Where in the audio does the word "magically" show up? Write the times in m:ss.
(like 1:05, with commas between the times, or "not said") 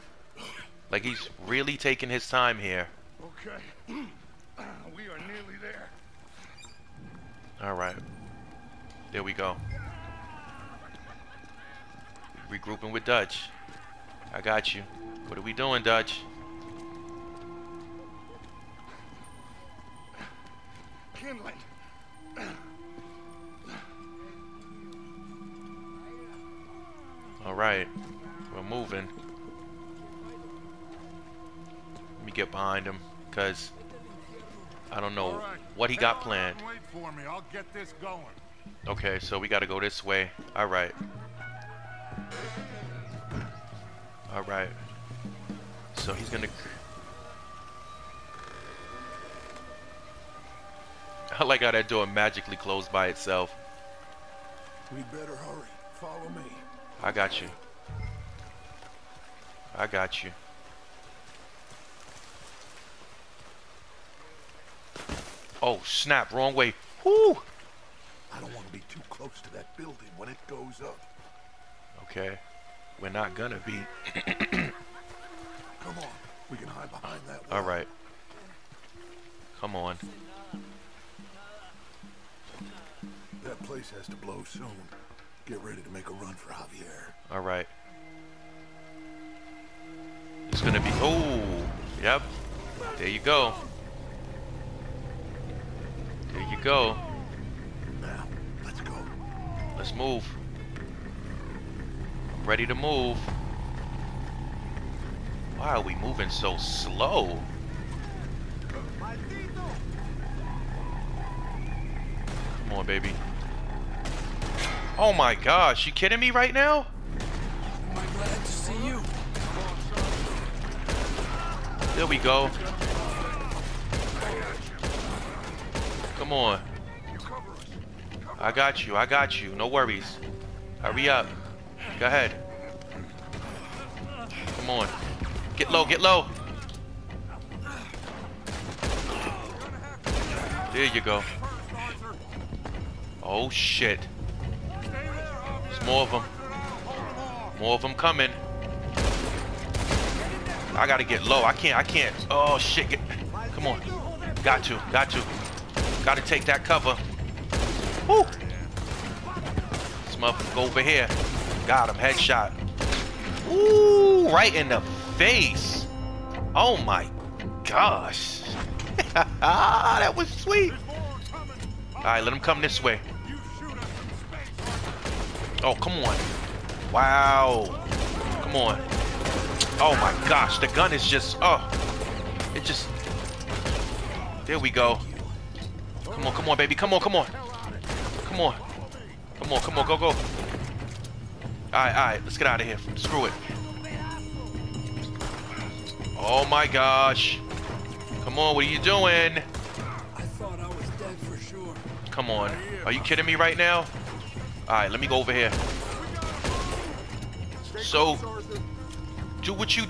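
0:52.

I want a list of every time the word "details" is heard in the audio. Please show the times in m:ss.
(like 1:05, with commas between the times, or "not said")
not said.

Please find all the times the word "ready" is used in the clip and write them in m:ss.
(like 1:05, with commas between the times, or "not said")
1:25, 1:42.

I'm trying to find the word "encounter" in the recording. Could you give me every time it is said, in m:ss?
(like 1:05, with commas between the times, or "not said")
not said.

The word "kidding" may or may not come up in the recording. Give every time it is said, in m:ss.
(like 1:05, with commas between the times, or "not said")
1:55, 3:22.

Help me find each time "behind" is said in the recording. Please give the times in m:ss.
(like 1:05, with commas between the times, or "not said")
0:32, 1:16.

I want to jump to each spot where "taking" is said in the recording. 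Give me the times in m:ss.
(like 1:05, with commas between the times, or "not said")
0:01.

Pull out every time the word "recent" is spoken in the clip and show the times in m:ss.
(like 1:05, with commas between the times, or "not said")
not said.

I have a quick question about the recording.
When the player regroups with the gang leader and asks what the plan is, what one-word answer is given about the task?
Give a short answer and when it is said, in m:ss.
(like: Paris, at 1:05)
Kindling, at 0:21.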